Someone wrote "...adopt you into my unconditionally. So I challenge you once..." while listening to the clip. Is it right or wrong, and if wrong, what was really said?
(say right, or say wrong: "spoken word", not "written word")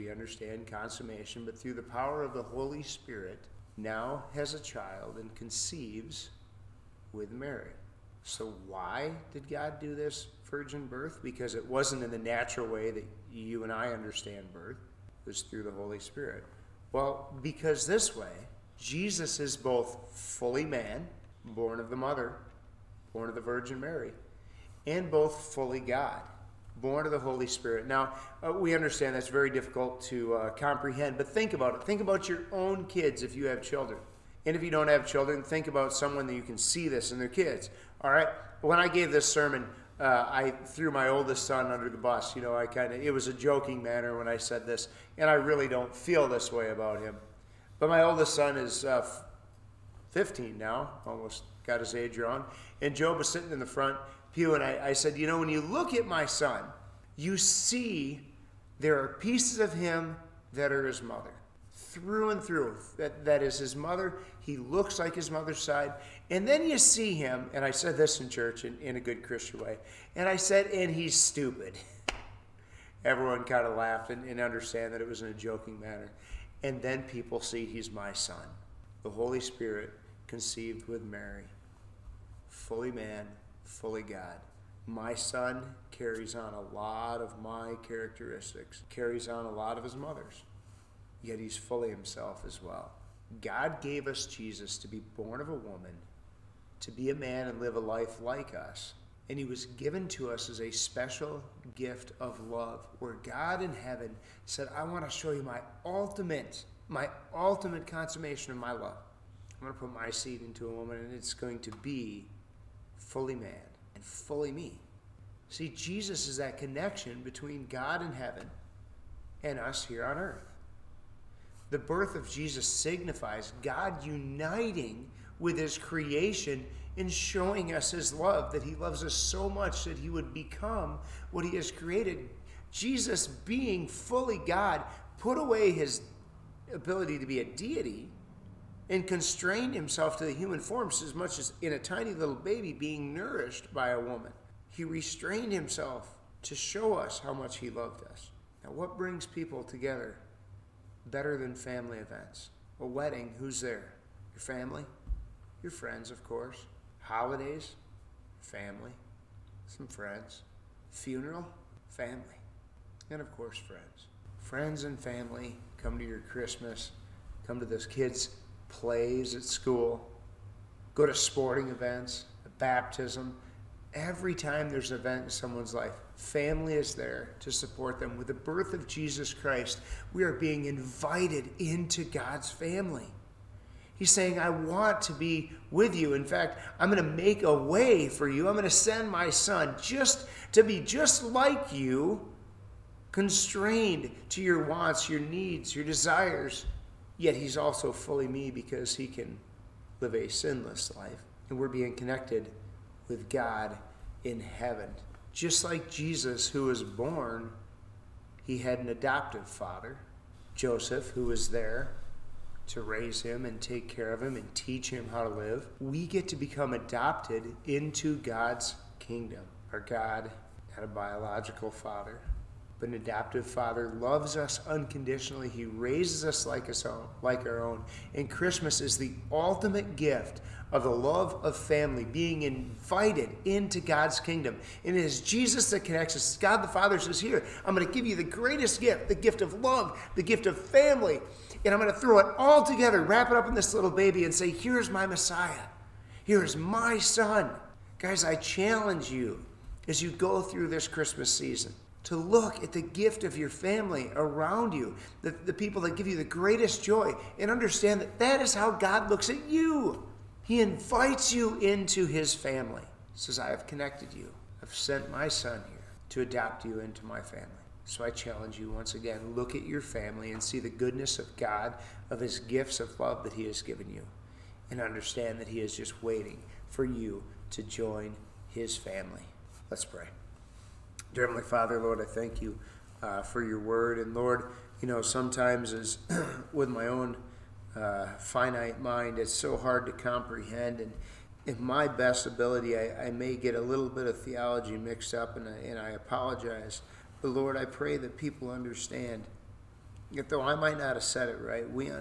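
wrong: "family", not "unconditionally".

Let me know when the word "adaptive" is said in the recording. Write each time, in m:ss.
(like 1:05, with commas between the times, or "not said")
3:43.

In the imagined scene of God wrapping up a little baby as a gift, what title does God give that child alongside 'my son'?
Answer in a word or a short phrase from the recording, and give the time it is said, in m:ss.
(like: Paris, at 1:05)
Messiah, at 4:05.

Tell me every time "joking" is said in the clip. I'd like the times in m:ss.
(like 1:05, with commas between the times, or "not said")
0:43, 1:15.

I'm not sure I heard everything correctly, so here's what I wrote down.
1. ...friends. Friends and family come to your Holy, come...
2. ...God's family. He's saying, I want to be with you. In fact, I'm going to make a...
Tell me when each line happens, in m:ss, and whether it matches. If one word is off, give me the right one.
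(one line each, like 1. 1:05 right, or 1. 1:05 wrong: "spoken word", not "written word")
1. 2:43 wrong: "Christmas", not "Holy"
2. 3:02 right.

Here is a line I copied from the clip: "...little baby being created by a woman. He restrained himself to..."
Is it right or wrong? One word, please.
wrong.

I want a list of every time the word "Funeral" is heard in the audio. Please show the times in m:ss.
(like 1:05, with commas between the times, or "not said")
2:40.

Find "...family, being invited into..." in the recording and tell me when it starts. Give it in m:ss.
3:51.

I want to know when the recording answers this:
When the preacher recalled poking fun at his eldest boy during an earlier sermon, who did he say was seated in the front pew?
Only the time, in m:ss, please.
0:52.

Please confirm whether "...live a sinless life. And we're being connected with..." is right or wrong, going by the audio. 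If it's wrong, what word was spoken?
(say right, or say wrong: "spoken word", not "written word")
right.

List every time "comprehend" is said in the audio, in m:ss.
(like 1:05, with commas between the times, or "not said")
0:30, 4:49.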